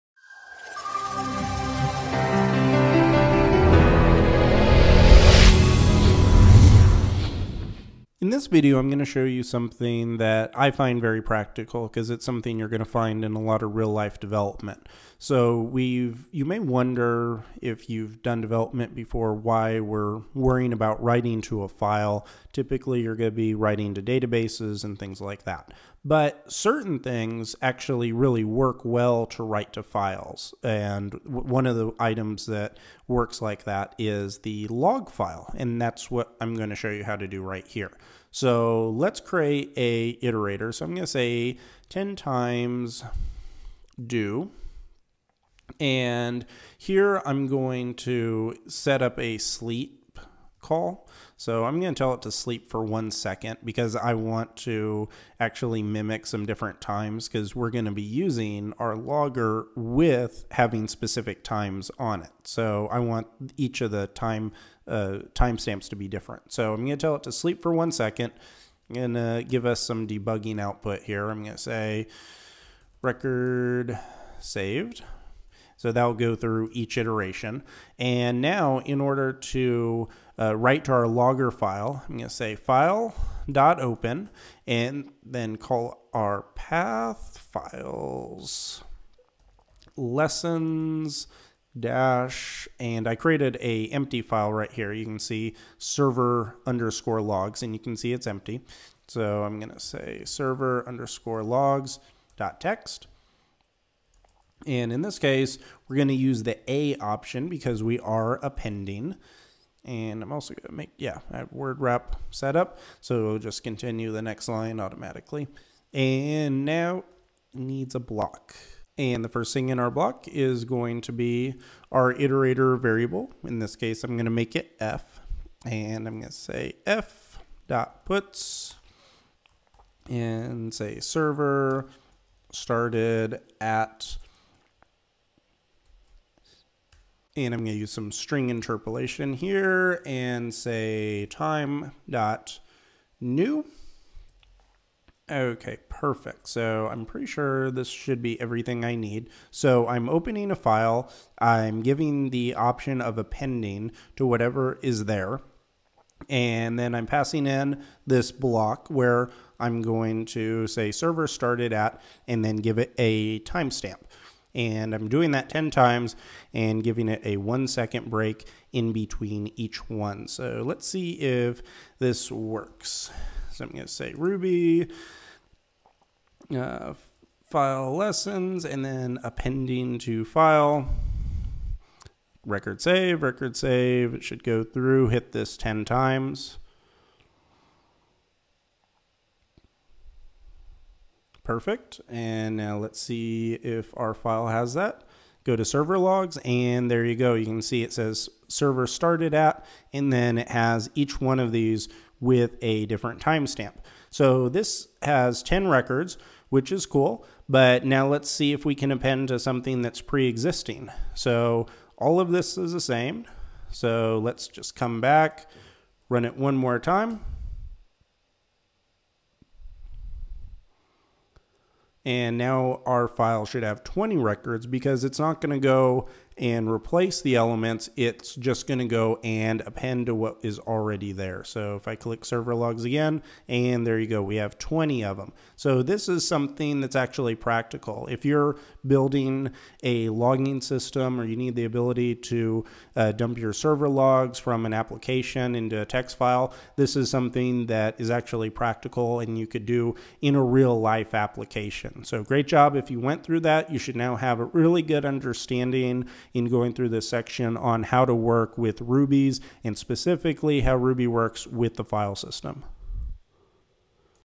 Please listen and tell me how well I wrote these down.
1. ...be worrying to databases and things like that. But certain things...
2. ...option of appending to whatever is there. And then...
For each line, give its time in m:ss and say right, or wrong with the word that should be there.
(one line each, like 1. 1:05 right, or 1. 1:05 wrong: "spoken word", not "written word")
1. 0:23 wrong: "writing", not "worrying"
2. 2:32 right.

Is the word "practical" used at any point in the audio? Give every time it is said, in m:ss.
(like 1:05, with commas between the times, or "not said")
0:11, 3:57, 4:08.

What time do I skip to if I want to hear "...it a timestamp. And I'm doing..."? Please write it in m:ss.
2:42.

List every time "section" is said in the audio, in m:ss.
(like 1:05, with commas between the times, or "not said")
4:17.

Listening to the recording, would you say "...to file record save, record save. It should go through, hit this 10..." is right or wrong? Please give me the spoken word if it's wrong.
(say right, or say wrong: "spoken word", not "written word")
right.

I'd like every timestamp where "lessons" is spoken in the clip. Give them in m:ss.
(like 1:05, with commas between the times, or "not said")
1:29, 2:57.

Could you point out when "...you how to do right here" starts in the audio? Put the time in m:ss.
0:36.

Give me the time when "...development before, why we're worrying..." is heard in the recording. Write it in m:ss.
0:18.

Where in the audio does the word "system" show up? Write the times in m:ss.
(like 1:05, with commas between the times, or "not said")
4:00, 4:22.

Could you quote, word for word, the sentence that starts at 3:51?
So if I click server logs again, and there you go, we have 20 of them.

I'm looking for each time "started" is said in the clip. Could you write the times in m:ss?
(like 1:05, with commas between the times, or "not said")
2:12, 2:41, 3:18.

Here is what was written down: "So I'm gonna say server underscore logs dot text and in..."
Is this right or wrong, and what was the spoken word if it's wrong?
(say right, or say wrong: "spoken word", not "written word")
right.